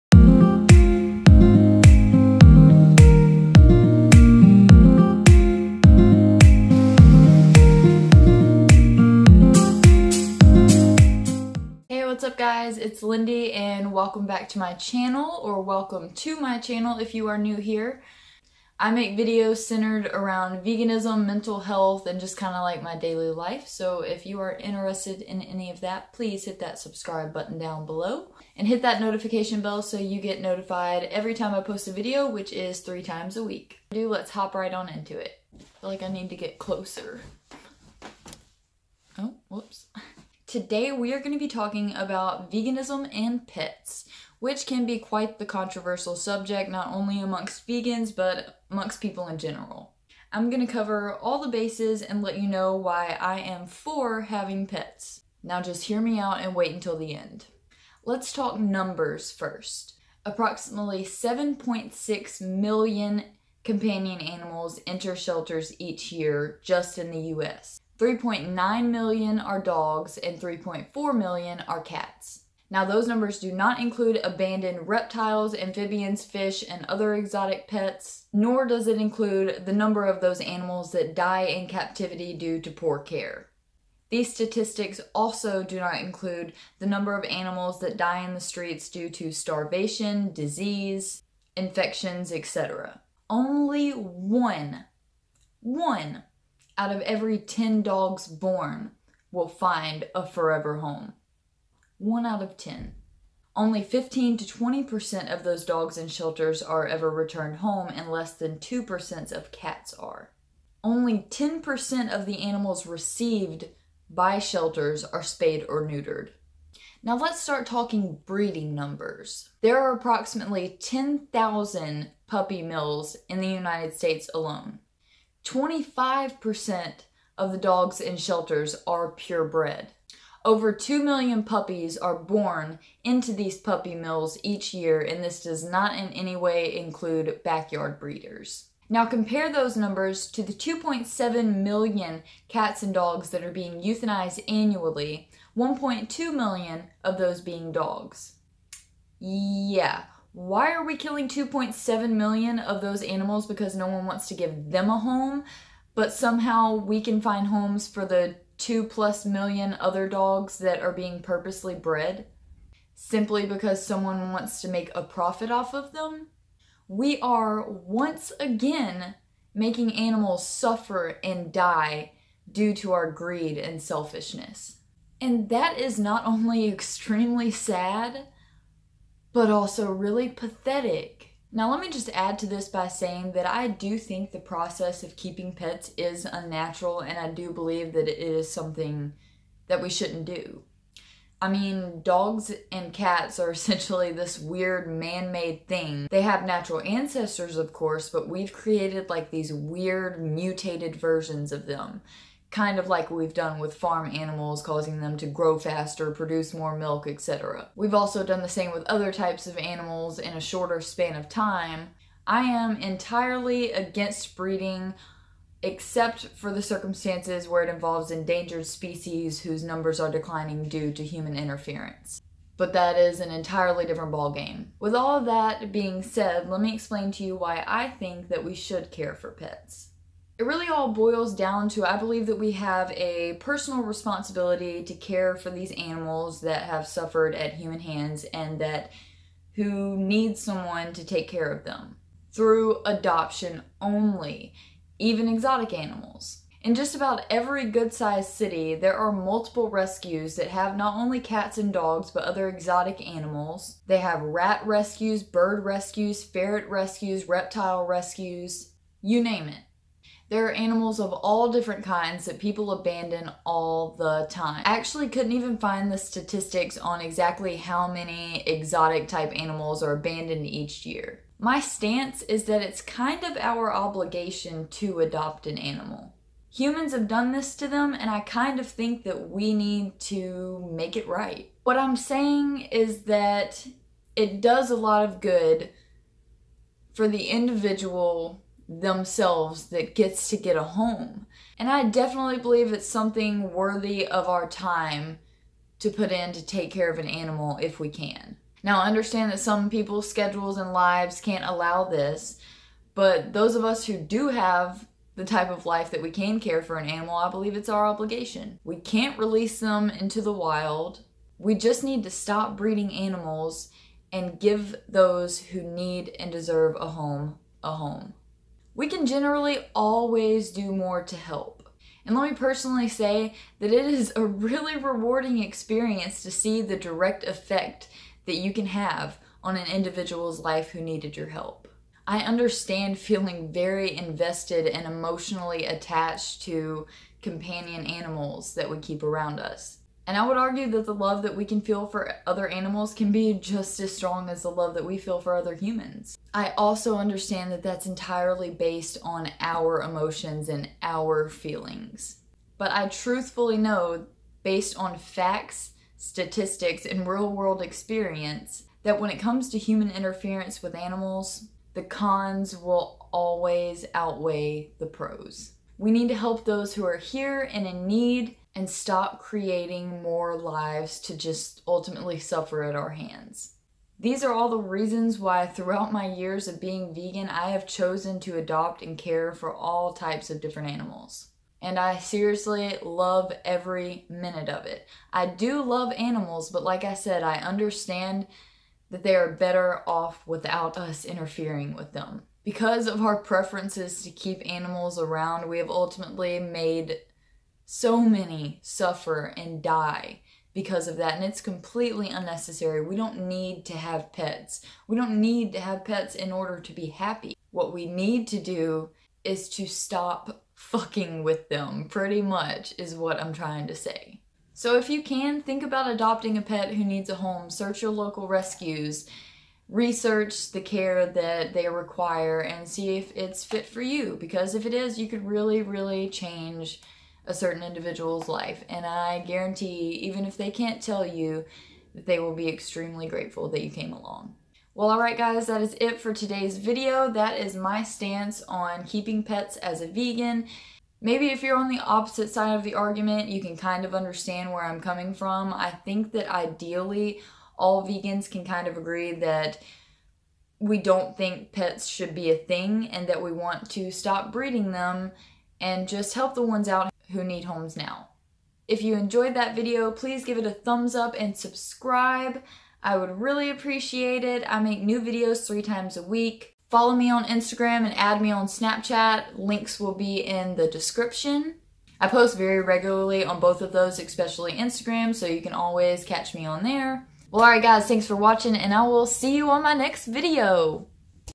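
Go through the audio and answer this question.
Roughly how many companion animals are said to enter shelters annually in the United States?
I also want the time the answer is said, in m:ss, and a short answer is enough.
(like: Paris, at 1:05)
7.6 million, at 1:01.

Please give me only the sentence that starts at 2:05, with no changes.
25% of the dogs in shelters are purebred.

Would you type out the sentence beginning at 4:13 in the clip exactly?
They have rat rescues, bird rescues, ferret rescues, reptile rescues, you name it.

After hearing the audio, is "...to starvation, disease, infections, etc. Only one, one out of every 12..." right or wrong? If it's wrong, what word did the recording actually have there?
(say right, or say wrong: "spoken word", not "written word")
wrong: "10", not "12".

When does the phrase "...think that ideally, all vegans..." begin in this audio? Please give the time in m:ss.
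7:25.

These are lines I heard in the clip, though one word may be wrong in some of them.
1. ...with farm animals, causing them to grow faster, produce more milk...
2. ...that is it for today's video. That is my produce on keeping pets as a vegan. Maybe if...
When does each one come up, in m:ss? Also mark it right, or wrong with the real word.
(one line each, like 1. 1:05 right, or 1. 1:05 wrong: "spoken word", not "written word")
1. 3:23 right
2. 7:15 wrong: "stance", not "produce".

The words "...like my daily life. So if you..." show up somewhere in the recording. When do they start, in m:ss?
0:22.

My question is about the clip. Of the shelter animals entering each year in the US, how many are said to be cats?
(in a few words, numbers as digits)
3.4 million.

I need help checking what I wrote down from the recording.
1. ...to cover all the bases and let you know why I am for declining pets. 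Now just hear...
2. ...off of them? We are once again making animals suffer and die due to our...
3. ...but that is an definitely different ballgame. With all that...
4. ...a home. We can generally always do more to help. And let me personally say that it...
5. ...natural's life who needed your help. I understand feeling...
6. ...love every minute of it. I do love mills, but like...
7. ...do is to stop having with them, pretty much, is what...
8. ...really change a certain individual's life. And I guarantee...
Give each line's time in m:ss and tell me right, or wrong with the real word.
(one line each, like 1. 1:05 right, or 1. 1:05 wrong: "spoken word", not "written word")
1. 0:50 wrong: "having", not "declining"
2. 2:45 right
3. 3:42 wrong: "entirely", not "definitely"
4. 5:17 right
5. 5:29 wrong: "individual", not "natural"
6. 6:22 wrong: "animals", not "mills"
7. 6:48 wrong: "fucking", not "having"
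8. 7:05 right.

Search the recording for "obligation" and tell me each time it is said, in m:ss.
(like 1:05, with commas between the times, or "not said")
4:33, 5:07.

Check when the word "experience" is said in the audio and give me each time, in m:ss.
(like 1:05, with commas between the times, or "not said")
5:25, 5:57.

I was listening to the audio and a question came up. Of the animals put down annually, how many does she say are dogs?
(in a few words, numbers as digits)
1.2 million.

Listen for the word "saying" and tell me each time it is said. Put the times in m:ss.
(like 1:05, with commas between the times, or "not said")
3:02, 4:41.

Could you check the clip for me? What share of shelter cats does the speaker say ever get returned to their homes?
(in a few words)
less than 2%.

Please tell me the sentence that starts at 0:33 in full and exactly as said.
Do let's hop right on into it.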